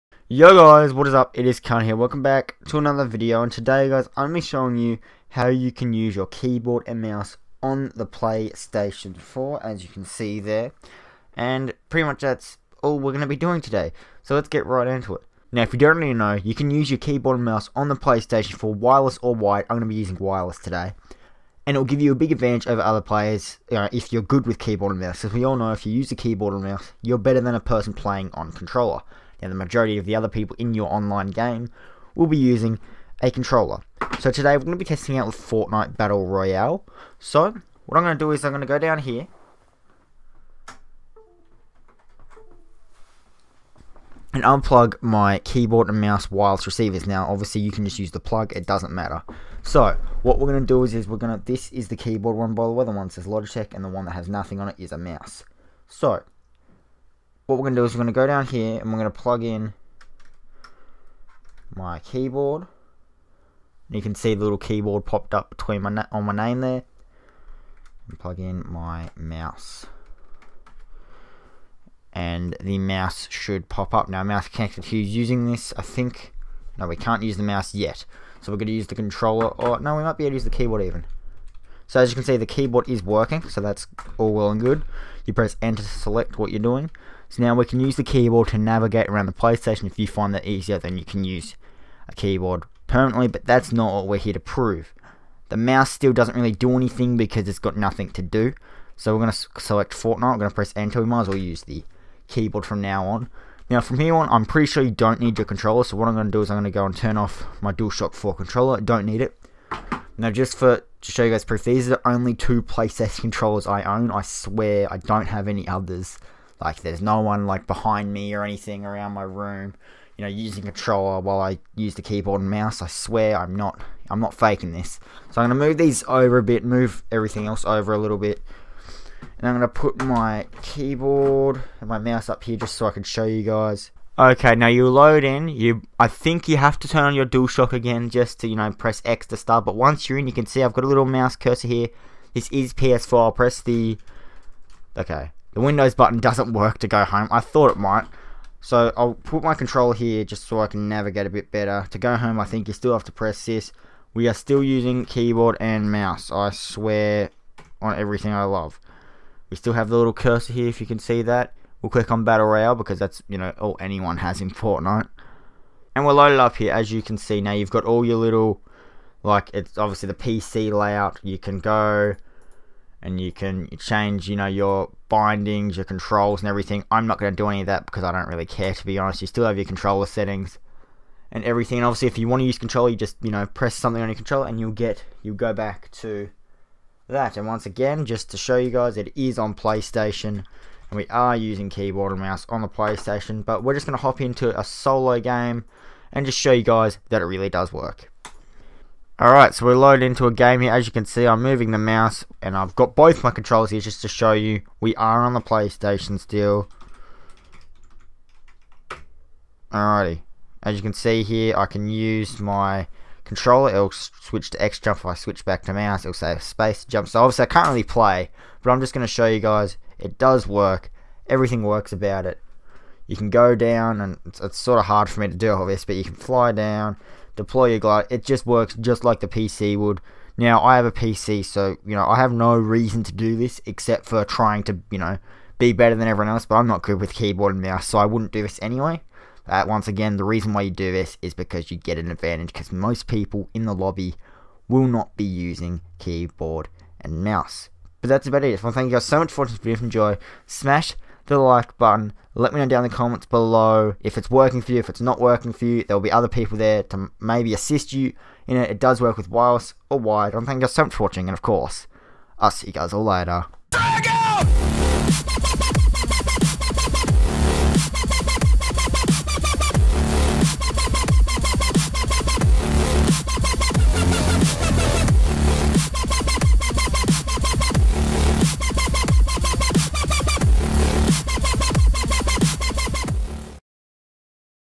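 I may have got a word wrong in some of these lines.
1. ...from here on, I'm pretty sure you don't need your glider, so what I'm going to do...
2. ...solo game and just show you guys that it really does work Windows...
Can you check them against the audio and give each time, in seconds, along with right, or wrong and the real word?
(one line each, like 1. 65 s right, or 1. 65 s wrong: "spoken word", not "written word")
1. 103 s wrong: "controller", not "glider"
2. 194 s wrong: "Alright", not "Windows".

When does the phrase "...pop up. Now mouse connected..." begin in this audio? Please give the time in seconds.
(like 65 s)
73 s.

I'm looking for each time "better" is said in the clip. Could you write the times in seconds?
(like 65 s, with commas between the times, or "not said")
27 s, 151 s, 235 s.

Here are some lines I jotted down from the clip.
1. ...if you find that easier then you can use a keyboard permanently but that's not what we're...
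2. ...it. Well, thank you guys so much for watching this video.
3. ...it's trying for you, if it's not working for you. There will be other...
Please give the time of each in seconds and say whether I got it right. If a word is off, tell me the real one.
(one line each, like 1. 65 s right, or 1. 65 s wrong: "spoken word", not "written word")
1. 89 s right
2. 248 s right
3. 254 s wrong: "working", not "trying".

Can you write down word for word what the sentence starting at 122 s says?
I swear I'm not I'm not faking this.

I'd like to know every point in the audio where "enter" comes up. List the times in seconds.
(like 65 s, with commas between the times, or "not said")
85 s, 100 s.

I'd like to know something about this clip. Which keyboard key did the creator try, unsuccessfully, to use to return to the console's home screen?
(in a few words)
The Windows button.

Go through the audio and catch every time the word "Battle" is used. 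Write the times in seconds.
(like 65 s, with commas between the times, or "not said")
35 s, 162 s.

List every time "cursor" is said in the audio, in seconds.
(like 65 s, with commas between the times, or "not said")
141 s, 160 s.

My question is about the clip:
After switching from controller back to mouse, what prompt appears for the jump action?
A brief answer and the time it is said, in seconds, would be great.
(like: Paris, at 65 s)
Space jump, at 216 s.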